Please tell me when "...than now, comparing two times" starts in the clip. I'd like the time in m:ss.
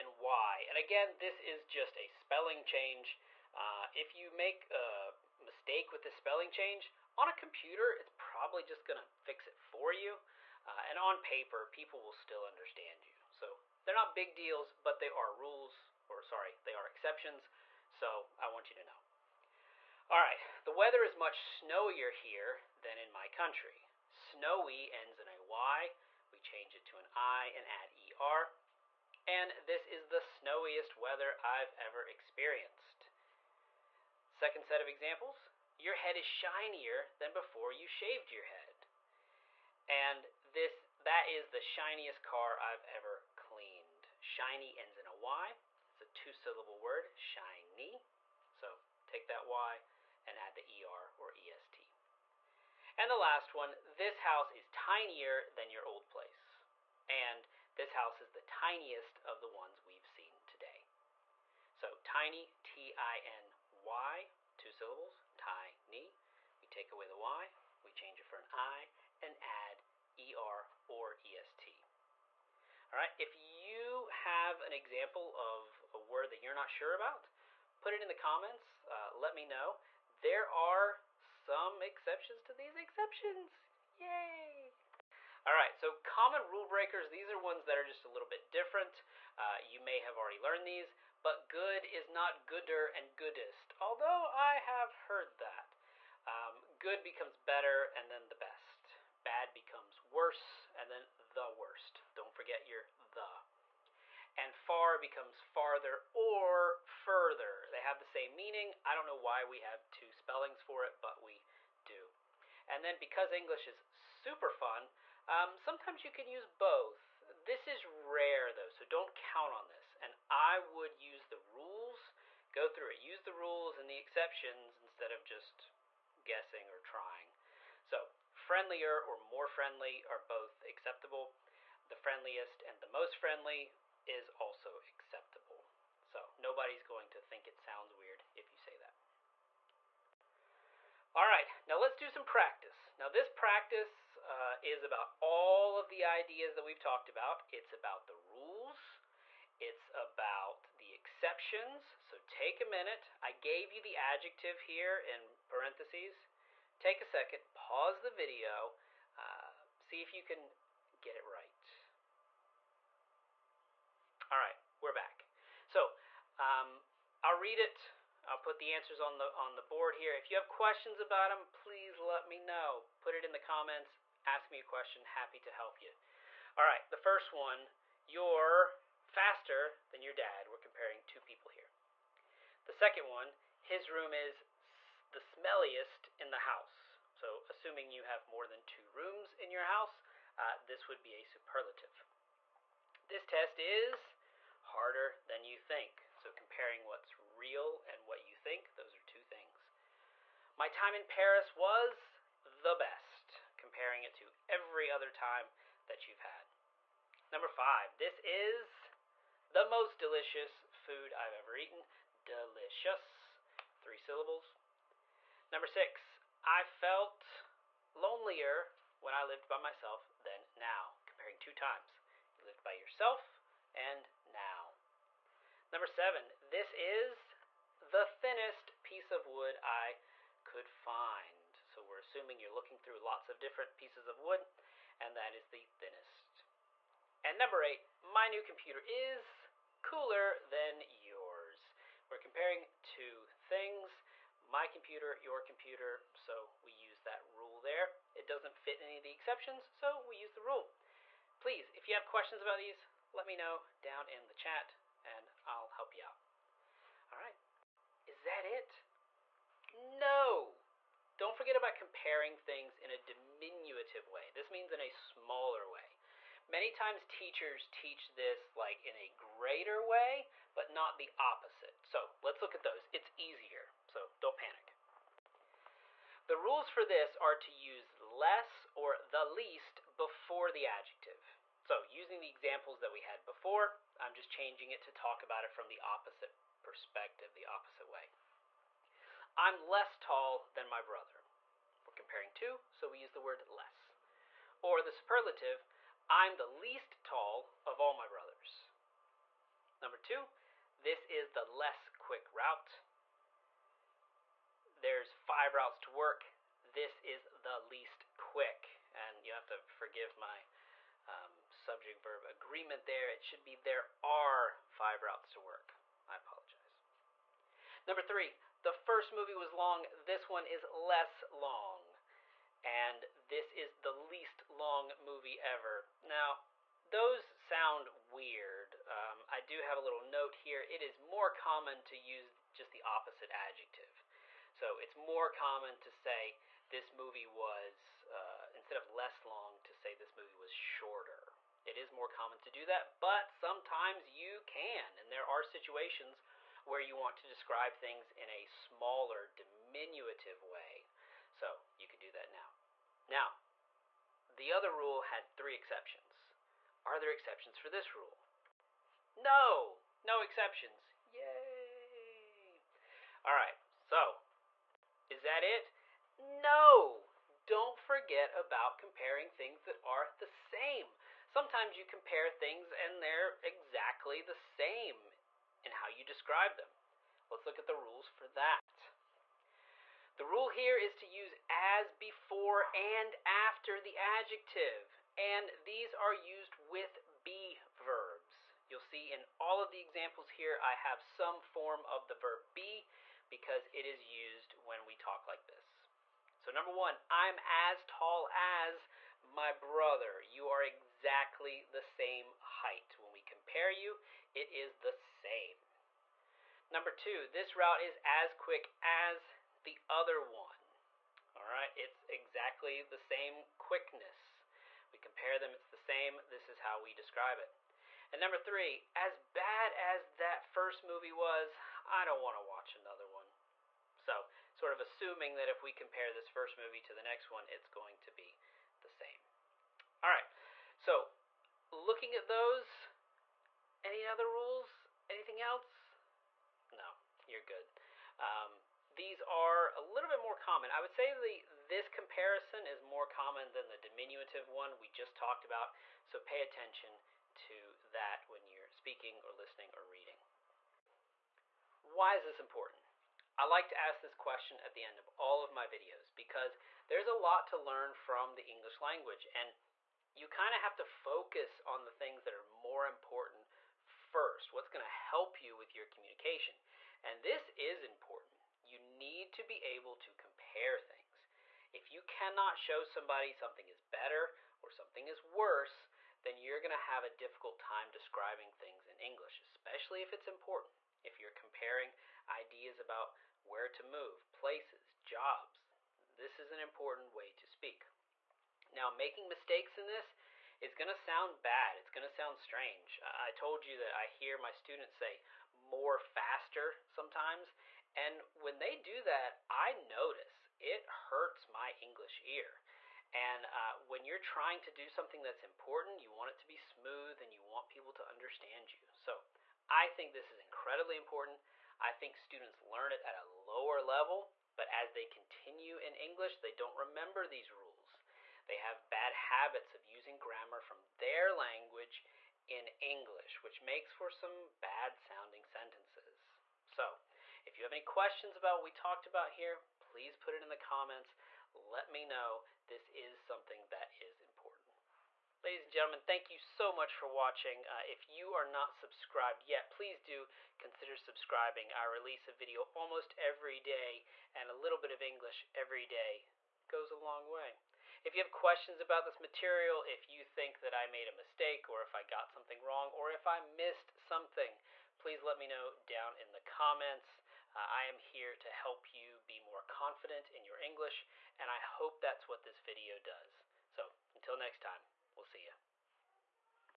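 3:40.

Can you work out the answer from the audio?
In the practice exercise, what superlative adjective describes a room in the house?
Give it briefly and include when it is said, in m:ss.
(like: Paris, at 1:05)
Smelliest, at 3:05.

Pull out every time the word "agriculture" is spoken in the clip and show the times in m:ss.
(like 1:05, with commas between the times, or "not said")
not said.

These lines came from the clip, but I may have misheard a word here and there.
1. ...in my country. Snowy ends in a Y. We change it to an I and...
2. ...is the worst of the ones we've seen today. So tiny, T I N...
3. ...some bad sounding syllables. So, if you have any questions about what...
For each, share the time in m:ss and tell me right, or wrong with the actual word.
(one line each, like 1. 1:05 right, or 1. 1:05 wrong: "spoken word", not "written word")
1. 0:22 right
2. 0:58 wrong: "tiniest", not "worst"
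3. 8:44 wrong: "sentences", not "syllables".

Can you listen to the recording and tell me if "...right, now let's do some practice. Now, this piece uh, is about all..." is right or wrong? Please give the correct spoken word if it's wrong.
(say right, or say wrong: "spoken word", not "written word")
wrong: "practice", not "piece".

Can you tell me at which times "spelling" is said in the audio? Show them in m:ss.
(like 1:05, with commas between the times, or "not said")
0:02, 0:06, 1:50.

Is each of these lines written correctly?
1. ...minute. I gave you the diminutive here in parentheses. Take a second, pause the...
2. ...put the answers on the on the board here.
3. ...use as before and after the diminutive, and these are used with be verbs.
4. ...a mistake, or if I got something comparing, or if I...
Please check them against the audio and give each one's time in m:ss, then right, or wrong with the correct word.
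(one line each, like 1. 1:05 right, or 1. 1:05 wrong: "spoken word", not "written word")
1. 2:32 wrong: "adjective", not "diminutive"
2. 2:48 right
3. 6:21 wrong: "adjective", not "diminutive"
4. 9:11 wrong: "wrong", not "comparing".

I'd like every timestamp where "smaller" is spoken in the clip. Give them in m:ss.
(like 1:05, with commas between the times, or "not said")
4:24, 5:48.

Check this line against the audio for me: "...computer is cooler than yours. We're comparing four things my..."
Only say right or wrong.
wrong.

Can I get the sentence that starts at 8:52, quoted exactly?
This is something that is important.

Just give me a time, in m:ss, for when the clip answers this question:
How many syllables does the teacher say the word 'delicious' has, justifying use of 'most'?
3:33.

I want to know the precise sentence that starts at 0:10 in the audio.
Uh, and on paper, people will still understand you.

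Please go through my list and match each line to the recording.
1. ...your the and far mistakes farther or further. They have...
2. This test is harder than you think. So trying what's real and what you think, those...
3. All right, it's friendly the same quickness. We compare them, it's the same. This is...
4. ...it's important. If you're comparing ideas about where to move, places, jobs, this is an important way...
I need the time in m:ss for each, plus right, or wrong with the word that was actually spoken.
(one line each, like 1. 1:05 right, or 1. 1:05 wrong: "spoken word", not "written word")
1. 1:42 wrong: "becomes", not "mistakes"
2. 3:13 wrong: "comparing", not "trying"
3. 6:51 wrong: "exactly", not "friendly"
4. 8:00 right.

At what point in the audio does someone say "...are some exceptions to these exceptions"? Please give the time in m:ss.
1:20.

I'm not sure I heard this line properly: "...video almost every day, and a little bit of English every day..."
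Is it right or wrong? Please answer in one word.
right.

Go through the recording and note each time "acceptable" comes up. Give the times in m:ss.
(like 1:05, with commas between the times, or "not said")
2:10, 2:14.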